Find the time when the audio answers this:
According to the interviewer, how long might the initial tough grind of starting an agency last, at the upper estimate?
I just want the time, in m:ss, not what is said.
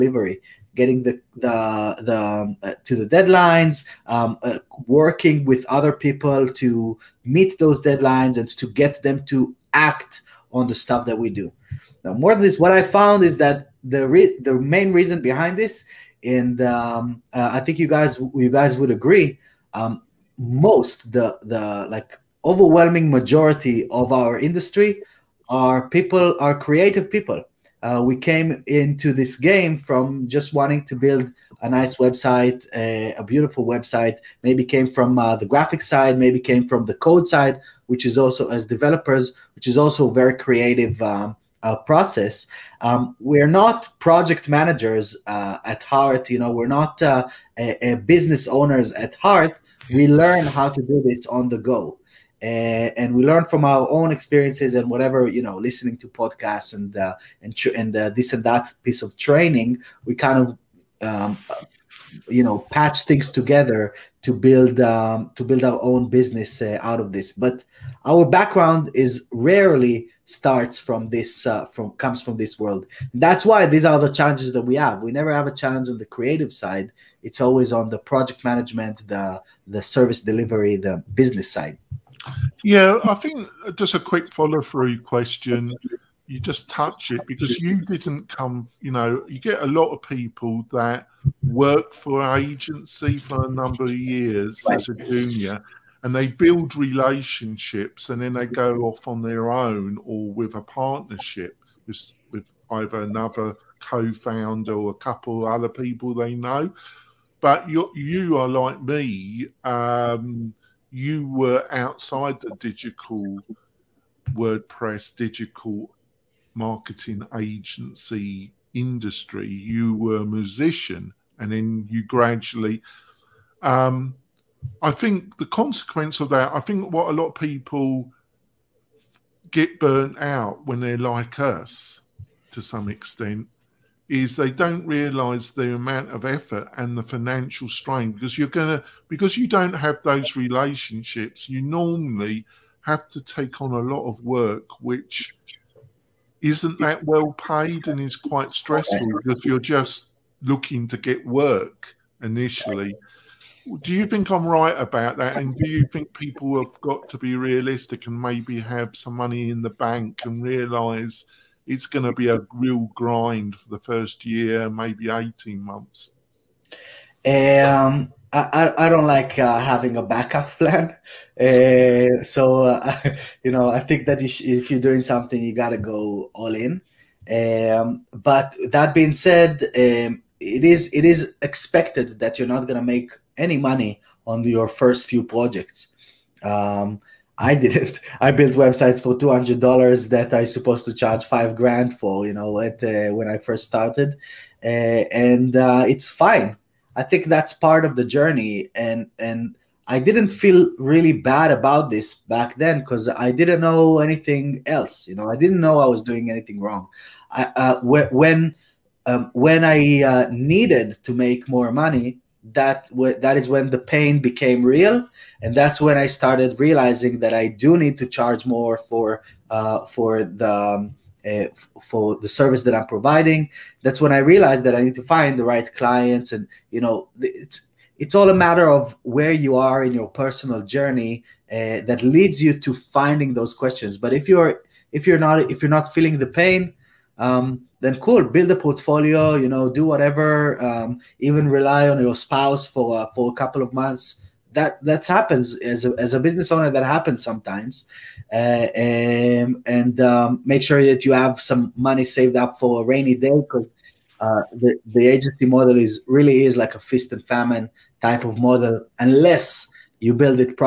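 2:45.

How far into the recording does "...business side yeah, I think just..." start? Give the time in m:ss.
1:21.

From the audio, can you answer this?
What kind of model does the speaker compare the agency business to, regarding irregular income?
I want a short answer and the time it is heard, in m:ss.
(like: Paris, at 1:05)
feast and famine, at 4:16.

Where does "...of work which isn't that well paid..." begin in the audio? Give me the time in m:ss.
2:24.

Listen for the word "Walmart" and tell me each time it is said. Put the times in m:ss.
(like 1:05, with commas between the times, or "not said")
not said.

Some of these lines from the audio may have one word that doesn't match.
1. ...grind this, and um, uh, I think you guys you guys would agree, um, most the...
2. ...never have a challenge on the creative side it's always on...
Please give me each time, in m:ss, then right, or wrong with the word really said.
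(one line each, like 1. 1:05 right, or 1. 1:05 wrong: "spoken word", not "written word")
1. 0:15 wrong: "behind", not "grind"
2. 1:15 right.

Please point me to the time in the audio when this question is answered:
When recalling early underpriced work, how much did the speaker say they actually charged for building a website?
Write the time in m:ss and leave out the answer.
3:09.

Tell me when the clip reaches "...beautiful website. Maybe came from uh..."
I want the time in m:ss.
0:33.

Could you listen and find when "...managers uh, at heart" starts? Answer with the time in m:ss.
0:44.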